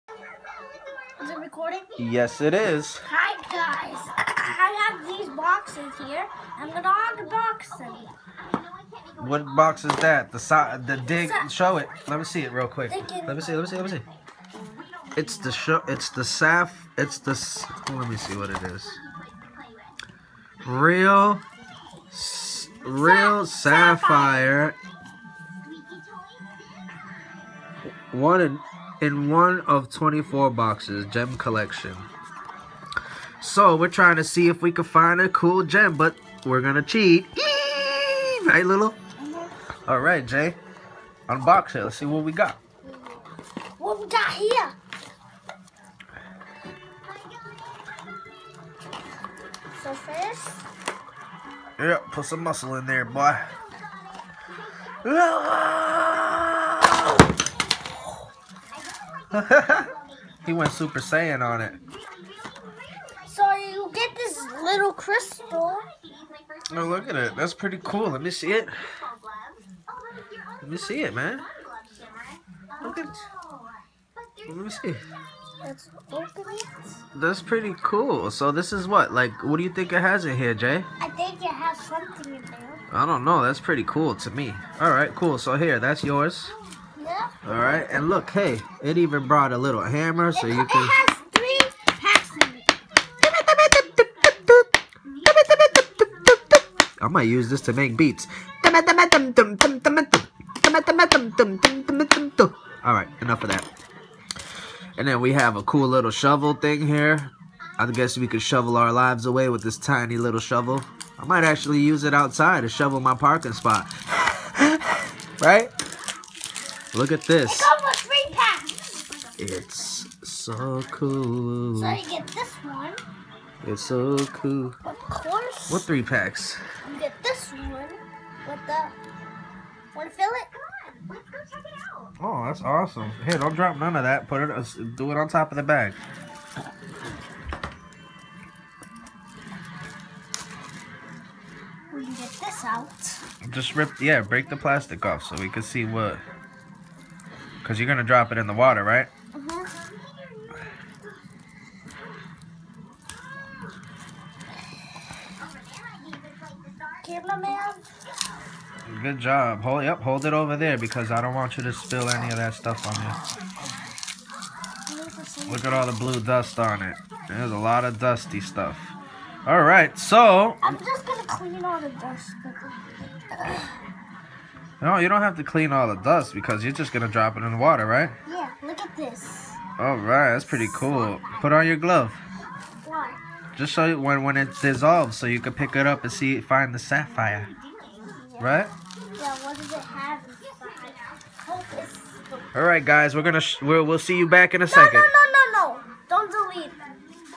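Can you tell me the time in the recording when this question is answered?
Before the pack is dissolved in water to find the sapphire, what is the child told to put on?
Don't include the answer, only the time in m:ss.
3:01.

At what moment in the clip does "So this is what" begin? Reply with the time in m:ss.
1:18.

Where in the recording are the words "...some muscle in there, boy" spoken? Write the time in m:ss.
0:52.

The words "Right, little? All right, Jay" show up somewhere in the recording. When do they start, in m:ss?
0:38.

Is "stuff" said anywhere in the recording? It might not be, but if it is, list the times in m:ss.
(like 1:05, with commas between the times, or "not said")
2:42, 2:48.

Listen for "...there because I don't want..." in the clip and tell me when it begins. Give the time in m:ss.
2:40.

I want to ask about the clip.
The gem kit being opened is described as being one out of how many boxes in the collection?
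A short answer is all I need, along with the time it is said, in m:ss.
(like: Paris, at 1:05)
24, at 0:29.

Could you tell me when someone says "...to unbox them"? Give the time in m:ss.
0:06.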